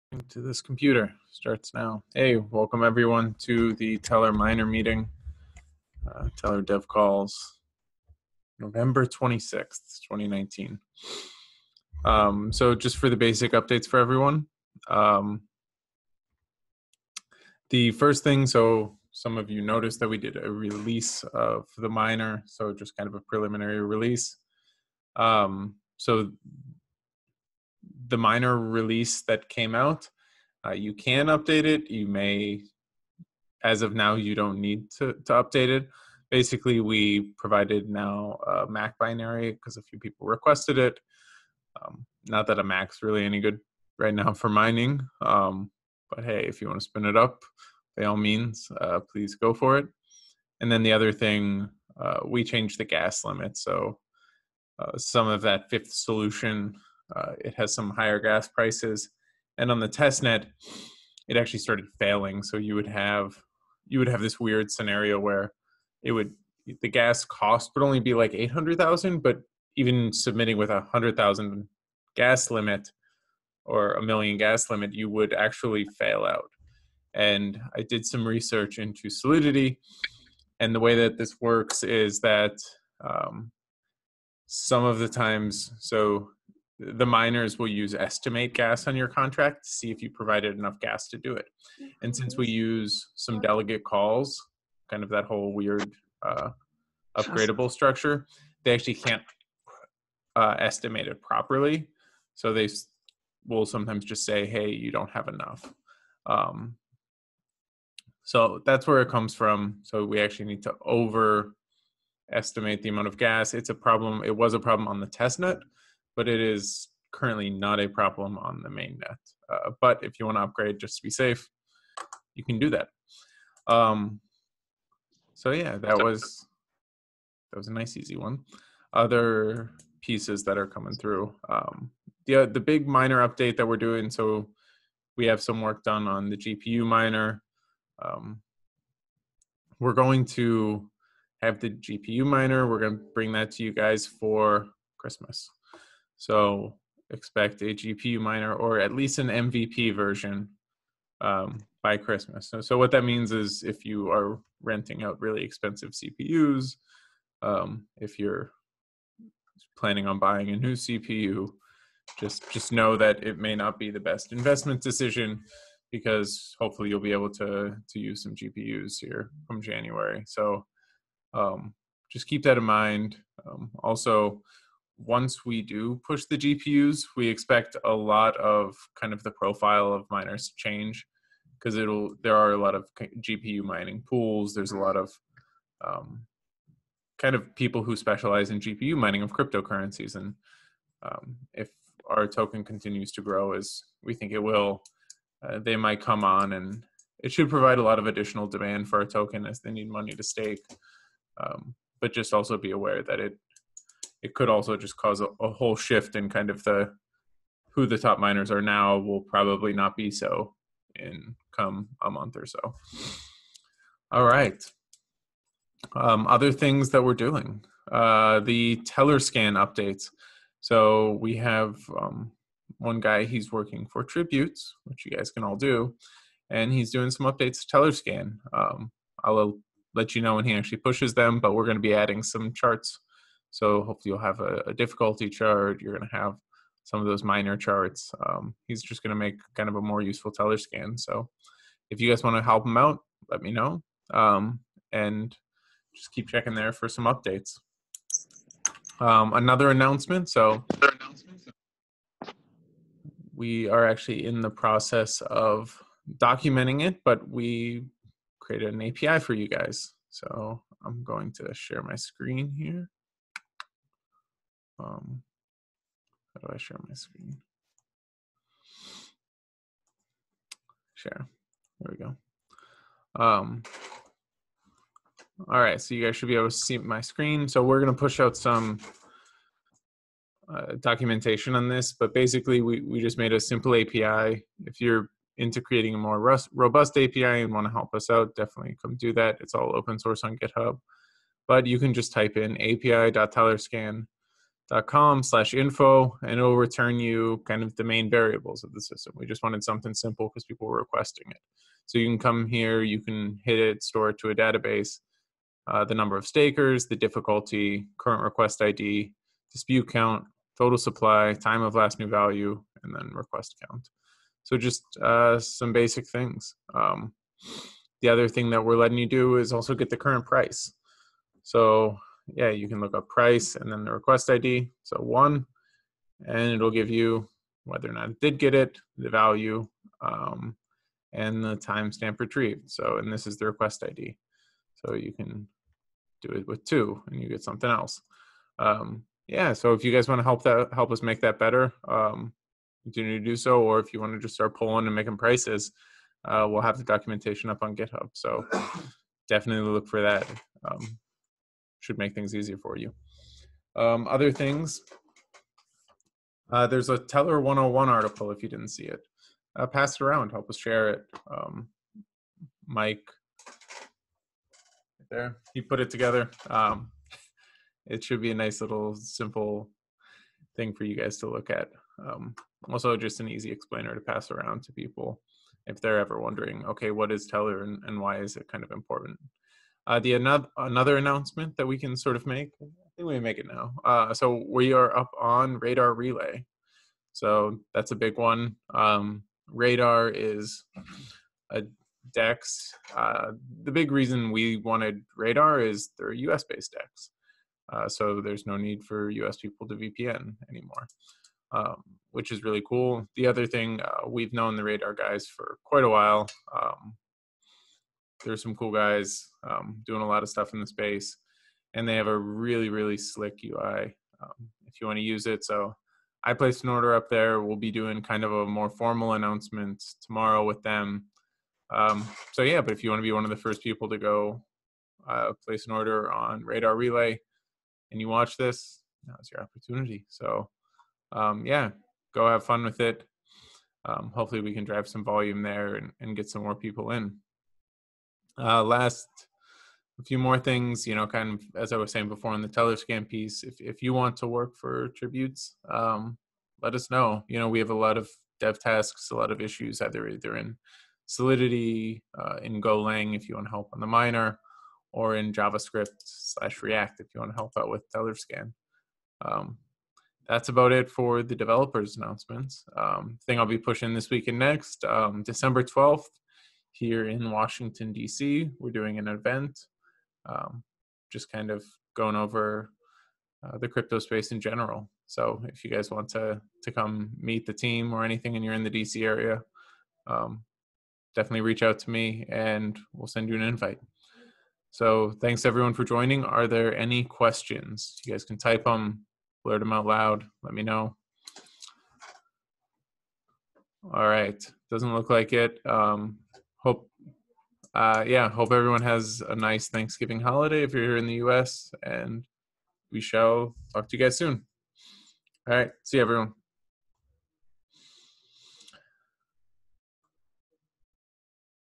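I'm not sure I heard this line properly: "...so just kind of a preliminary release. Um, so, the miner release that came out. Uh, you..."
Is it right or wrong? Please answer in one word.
right.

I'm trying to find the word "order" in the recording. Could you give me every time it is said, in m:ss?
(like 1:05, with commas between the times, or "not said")
6:56, 7:05.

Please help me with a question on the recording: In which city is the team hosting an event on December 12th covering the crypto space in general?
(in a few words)
Washington, D.C.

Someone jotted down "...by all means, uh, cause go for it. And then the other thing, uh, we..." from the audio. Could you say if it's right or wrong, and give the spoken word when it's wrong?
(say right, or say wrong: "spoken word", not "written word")
wrong: "please", not "cause".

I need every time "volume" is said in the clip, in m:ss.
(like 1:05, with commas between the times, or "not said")
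7:15.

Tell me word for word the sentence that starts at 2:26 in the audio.
So expect a GPU miner or at least an MVP version um, by Christmas.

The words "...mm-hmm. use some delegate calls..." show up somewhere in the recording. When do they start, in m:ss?
1:32.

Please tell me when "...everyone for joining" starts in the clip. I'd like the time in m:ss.
8:05.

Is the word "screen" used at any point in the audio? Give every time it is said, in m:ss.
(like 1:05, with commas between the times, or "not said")
4:21, 4:26, 4:37.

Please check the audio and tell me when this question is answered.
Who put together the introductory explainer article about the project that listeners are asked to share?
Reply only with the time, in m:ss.
6:02.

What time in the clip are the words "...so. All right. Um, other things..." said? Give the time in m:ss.
3:32.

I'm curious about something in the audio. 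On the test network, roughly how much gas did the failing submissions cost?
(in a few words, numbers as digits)
800,000.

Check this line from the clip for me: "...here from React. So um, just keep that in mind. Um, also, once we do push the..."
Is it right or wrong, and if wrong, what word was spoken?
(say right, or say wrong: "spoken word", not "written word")
wrong: "January", not "React".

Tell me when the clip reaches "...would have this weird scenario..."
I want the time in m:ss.
1:03.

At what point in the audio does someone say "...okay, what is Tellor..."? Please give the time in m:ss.
6:16.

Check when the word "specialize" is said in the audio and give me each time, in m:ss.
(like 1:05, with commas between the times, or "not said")
3:07.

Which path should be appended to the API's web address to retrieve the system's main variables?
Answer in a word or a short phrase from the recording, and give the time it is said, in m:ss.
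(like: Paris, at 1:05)
/info, at 4:55.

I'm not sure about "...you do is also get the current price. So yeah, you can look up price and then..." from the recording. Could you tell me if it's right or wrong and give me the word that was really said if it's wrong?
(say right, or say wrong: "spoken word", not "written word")
right.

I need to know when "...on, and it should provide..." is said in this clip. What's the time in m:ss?
3:16.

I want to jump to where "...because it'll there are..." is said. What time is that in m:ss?
3:01.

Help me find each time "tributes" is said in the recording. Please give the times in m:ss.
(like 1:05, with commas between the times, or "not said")
3:44, 7:24.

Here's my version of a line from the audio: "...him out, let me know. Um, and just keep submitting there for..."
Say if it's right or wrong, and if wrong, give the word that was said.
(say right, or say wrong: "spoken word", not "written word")
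wrong: "checking", not "submitting".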